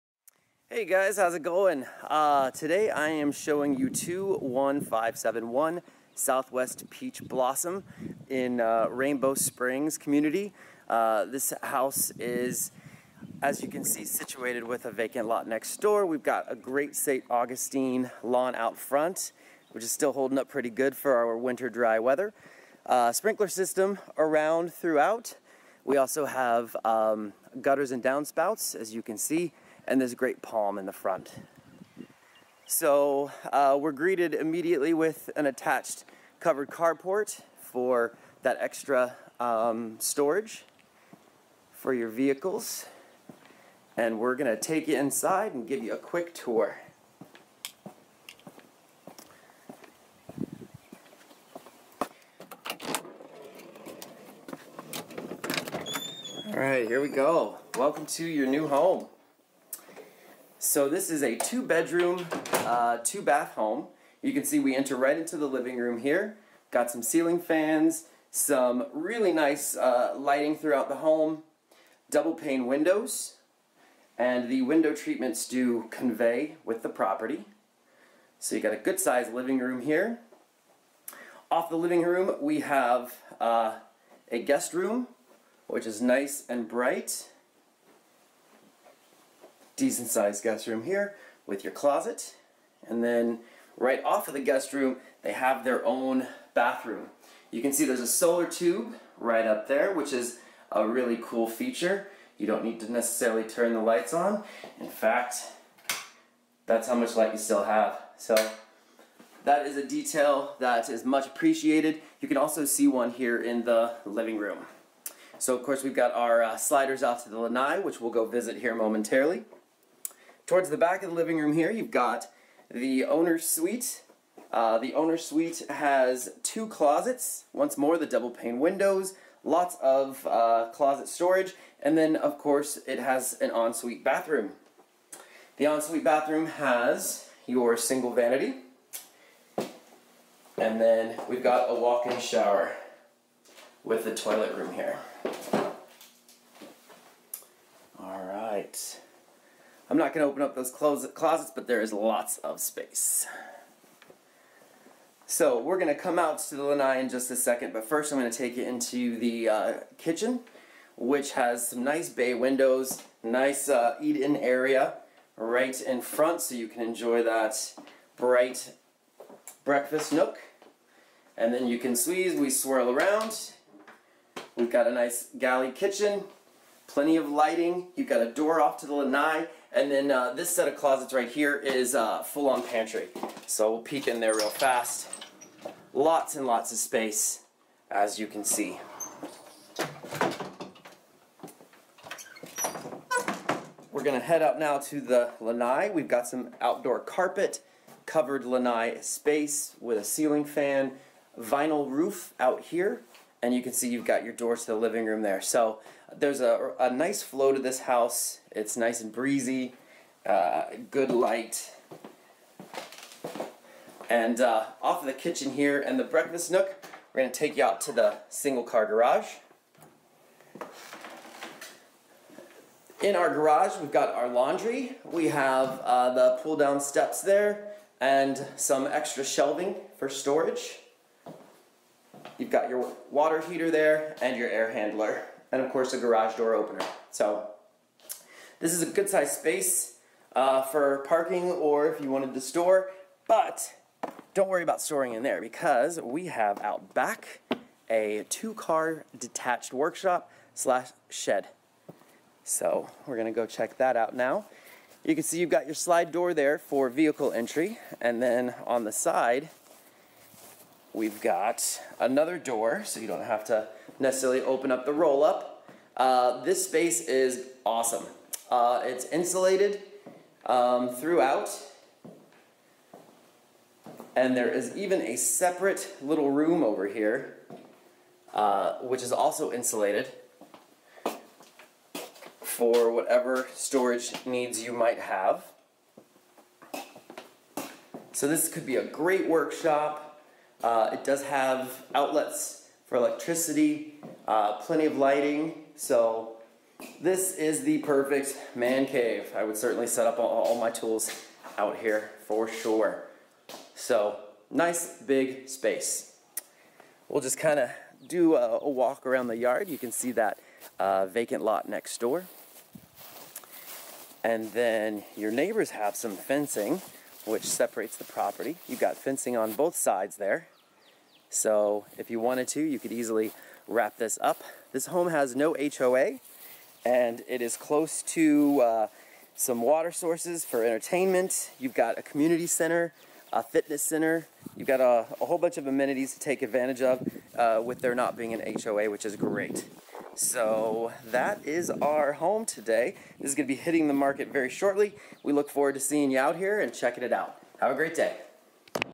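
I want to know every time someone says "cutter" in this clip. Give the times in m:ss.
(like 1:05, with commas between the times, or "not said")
not said.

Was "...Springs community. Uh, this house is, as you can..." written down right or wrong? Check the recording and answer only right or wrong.
right.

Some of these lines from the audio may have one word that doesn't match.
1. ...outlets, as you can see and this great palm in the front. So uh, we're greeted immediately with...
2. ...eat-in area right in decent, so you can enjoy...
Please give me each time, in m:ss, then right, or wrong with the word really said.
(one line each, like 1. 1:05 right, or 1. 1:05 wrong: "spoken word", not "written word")
1. 0:28 wrong: "downspouts", not "outlets"
2. 2:44 wrong: "front", not "decent".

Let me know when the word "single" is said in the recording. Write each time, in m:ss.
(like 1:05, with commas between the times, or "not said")
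2:17, 3:38.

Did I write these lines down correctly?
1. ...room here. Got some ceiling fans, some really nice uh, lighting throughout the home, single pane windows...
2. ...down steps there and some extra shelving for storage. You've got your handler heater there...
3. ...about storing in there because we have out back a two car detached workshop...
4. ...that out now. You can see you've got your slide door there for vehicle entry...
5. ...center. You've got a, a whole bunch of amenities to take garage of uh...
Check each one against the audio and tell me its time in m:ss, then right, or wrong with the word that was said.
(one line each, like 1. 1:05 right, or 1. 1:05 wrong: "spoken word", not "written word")
1. 1:05 wrong: "double", not "single"
2. 3:46 wrong: "water", not "handler"
3. 4:04 right
4. 4:13 right
5. 5:33 wrong: "advantage", not "garage".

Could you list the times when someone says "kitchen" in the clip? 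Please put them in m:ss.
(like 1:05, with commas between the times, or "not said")
2:39, 2:55, 3:35.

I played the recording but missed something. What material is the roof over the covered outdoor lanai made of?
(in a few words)
Vinyl.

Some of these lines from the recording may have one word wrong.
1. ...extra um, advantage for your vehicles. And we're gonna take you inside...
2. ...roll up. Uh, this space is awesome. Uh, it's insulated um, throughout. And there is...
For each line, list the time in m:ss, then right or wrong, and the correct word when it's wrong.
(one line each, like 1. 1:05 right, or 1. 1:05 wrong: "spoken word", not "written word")
1. 0:38 wrong: "storage", not "advantage"
2. 4:24 right.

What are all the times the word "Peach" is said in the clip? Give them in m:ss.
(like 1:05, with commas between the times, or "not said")
0:06.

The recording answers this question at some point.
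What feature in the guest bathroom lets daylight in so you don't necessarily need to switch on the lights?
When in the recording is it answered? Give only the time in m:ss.
1:38.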